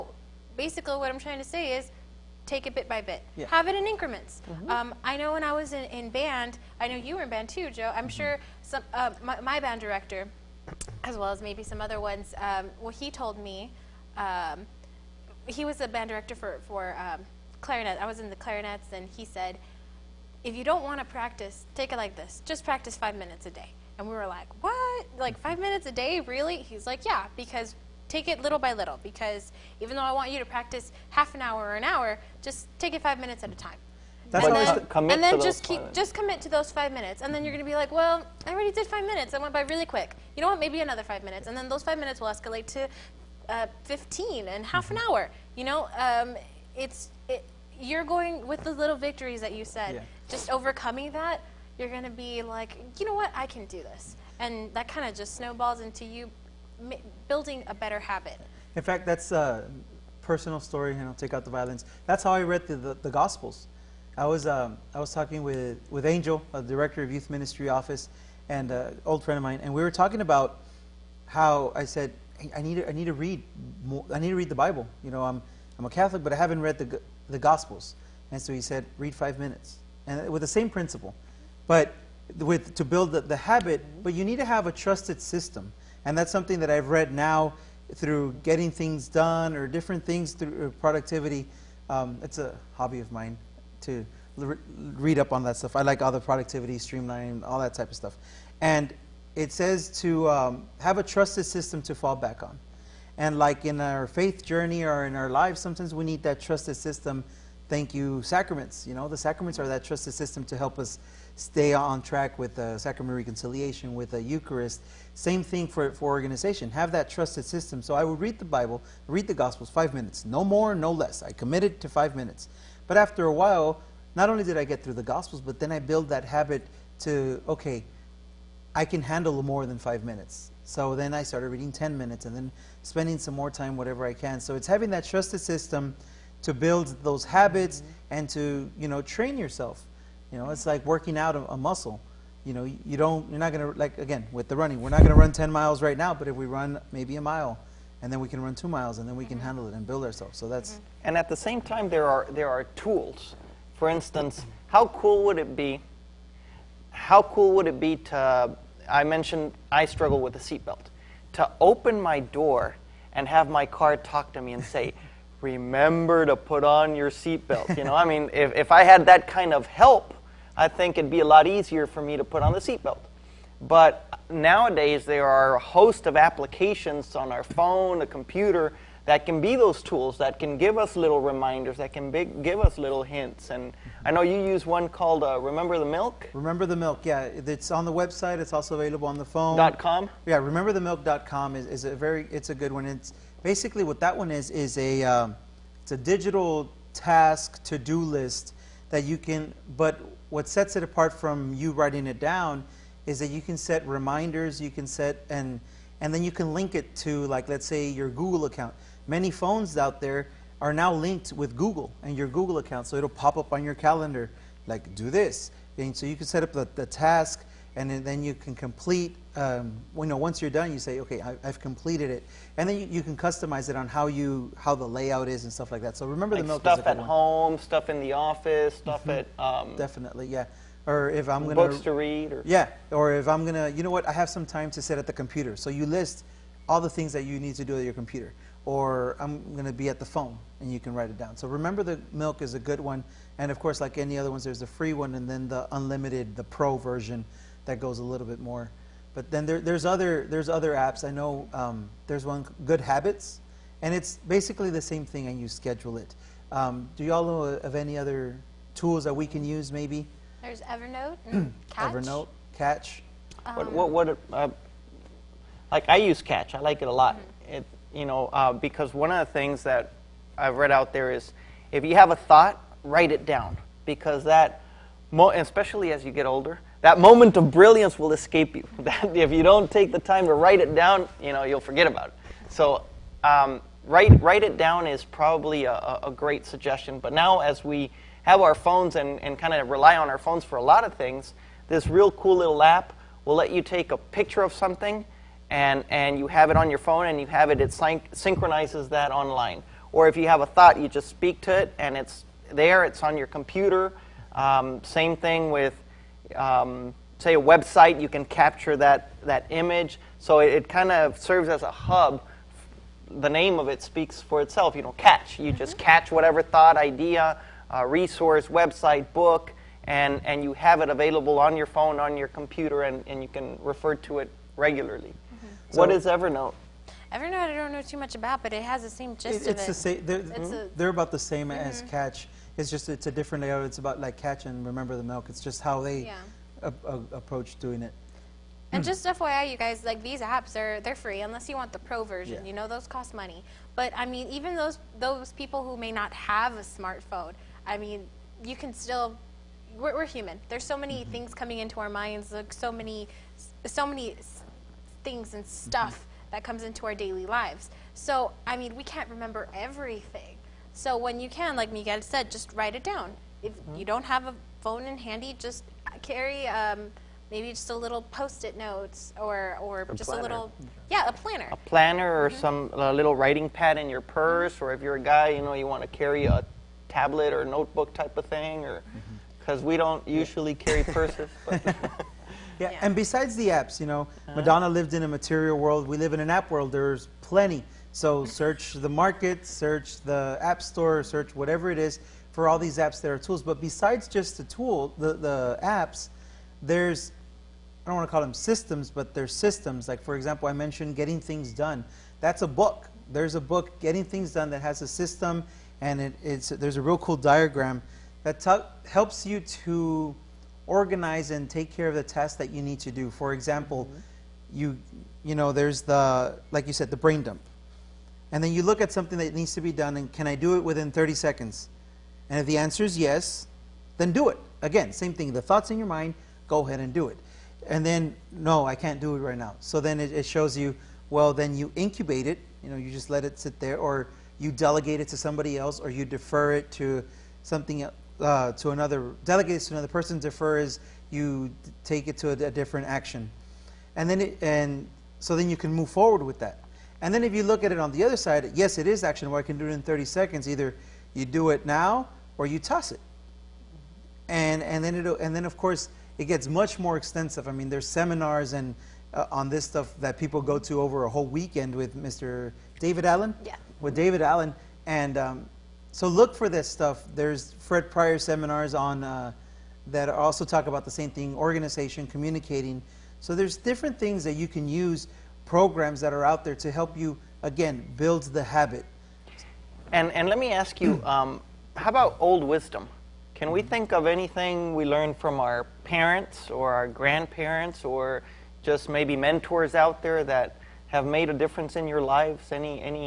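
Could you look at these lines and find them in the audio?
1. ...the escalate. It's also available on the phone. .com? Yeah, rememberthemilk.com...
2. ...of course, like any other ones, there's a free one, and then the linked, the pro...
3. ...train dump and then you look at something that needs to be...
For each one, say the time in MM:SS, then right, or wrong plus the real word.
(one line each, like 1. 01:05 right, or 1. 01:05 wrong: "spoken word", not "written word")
1. 03:07 wrong: "website", not "escalate"
2. 04:03 wrong: "unlimited", not "linked"
3. 06:57 wrong: "brain", not "train".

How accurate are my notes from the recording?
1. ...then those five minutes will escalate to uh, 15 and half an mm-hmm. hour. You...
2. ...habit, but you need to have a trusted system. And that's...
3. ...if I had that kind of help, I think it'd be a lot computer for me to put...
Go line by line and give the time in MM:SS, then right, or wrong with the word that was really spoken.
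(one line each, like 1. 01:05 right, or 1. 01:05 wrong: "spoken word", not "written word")
1. 00:41 right
2. 01:23 right
3. 02:48 wrong: "easier", not "computer".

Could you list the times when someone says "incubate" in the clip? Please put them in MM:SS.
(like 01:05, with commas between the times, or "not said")
07:11.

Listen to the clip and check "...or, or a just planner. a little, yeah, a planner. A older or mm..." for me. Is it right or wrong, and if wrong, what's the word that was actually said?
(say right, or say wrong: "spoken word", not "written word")
wrong: "planner", not "older".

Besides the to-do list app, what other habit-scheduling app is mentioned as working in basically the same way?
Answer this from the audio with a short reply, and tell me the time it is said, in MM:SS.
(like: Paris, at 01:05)
Good Habits, at 04:12.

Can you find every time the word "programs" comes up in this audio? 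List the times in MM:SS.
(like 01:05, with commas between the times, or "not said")
07:55.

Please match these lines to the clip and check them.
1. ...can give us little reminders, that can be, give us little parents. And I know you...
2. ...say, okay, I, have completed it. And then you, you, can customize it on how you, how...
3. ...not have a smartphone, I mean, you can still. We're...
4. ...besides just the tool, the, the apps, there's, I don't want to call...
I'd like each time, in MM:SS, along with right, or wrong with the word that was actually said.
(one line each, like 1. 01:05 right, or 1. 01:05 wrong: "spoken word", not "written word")
1. 03:00 wrong: "hints", not "parents"
2. 03:40 right
3. 05:45 right
4. 06:33 right.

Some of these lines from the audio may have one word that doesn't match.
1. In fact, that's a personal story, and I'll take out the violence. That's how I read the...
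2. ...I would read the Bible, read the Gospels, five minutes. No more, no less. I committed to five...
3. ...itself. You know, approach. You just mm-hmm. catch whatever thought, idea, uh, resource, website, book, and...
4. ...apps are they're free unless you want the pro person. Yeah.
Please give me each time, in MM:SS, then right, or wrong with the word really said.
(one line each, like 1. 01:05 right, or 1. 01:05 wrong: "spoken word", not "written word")
1. 00:58 right
2. 01:57 right
3. 05:14 wrong: "catch", not "approach"
4. 05:40 wrong: "version", not "person".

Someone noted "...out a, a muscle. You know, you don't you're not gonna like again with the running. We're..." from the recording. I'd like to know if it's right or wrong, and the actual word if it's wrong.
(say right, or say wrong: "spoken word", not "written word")
right.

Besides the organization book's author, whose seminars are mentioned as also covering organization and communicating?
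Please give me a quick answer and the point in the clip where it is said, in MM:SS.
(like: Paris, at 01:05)
Fred Pryor, at 07:47.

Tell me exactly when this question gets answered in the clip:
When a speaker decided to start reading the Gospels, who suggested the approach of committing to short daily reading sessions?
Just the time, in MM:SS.
01:06.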